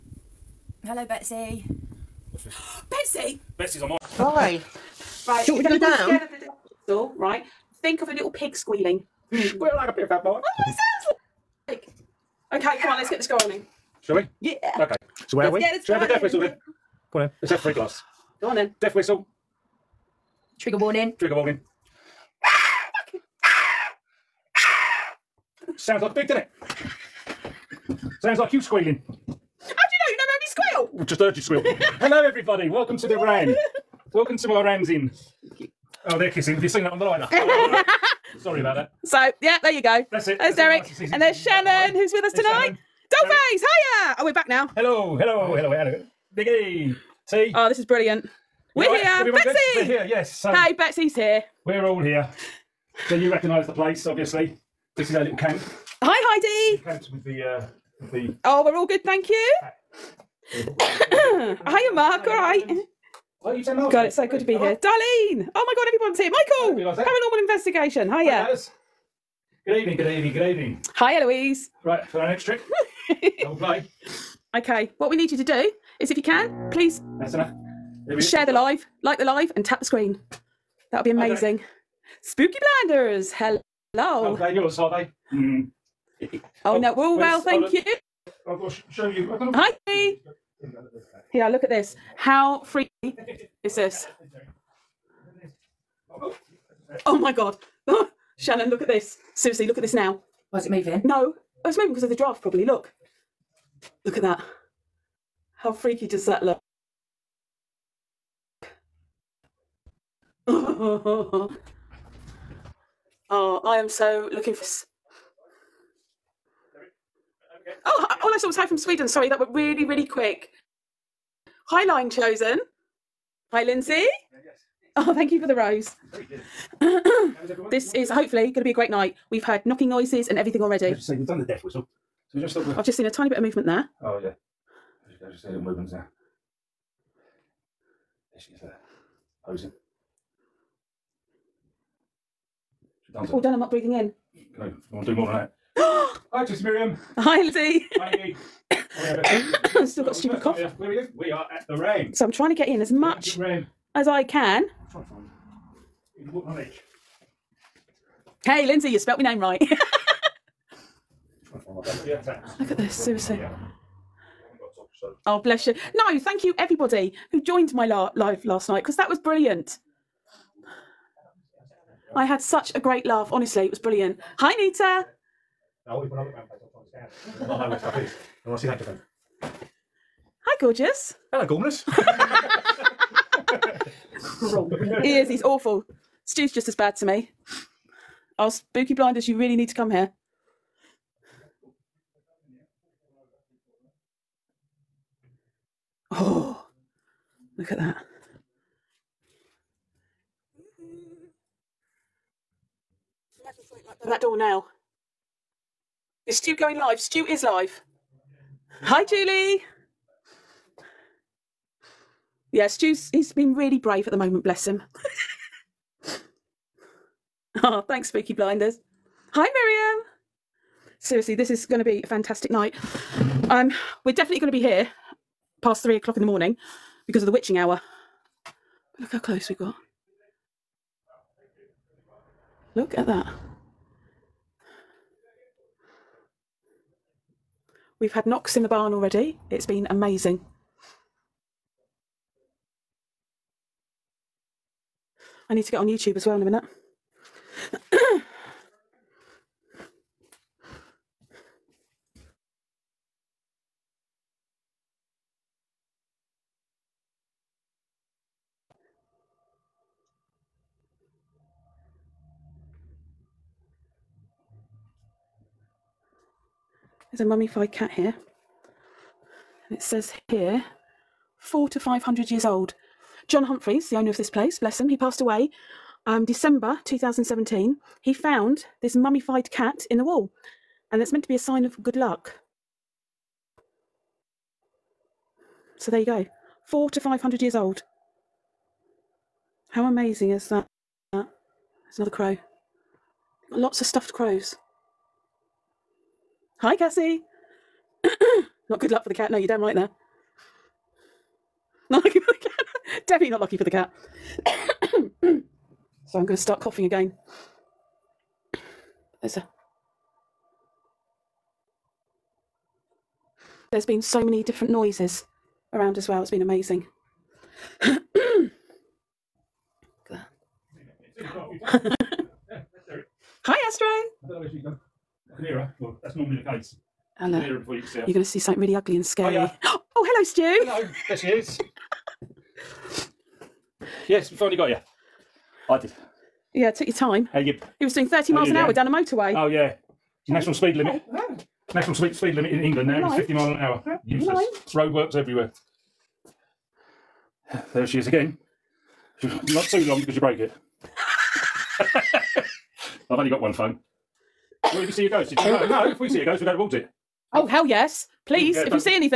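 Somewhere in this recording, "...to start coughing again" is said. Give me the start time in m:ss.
5:06.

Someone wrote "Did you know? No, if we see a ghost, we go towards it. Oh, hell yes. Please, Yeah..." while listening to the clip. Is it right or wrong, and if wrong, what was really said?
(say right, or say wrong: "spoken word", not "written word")
right.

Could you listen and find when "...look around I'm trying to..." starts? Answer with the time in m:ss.
2:56.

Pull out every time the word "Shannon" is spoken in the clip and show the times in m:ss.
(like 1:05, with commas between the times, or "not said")
0:41, 1:38.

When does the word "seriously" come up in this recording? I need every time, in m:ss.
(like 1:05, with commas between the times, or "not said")
1:39, 2:42, 3:40.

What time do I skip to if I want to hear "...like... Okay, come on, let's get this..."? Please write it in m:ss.
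0:11.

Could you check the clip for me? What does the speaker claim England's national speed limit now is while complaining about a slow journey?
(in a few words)
50 miles an hour.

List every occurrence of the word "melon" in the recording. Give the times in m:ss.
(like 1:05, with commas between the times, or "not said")
not said.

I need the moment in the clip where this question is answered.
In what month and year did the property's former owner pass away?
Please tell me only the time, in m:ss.
4:36.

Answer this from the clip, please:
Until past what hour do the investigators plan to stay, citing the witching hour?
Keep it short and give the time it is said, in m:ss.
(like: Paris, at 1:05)
3 o'clock, at 3:45.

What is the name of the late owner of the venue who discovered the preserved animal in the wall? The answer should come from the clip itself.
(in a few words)
John Humphries.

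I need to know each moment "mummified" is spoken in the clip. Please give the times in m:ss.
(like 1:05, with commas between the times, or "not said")
4:27, 4:38.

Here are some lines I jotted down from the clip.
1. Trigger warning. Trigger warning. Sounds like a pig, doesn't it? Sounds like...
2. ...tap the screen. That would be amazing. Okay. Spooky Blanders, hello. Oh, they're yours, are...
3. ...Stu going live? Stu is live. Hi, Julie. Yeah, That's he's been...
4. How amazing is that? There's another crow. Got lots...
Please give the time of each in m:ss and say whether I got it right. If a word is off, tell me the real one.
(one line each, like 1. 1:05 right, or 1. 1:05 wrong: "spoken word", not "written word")
1. 0:20 right
2. 1:19 right
3. 3:26 wrong: "Stu", not "That"
4. 4:49 right.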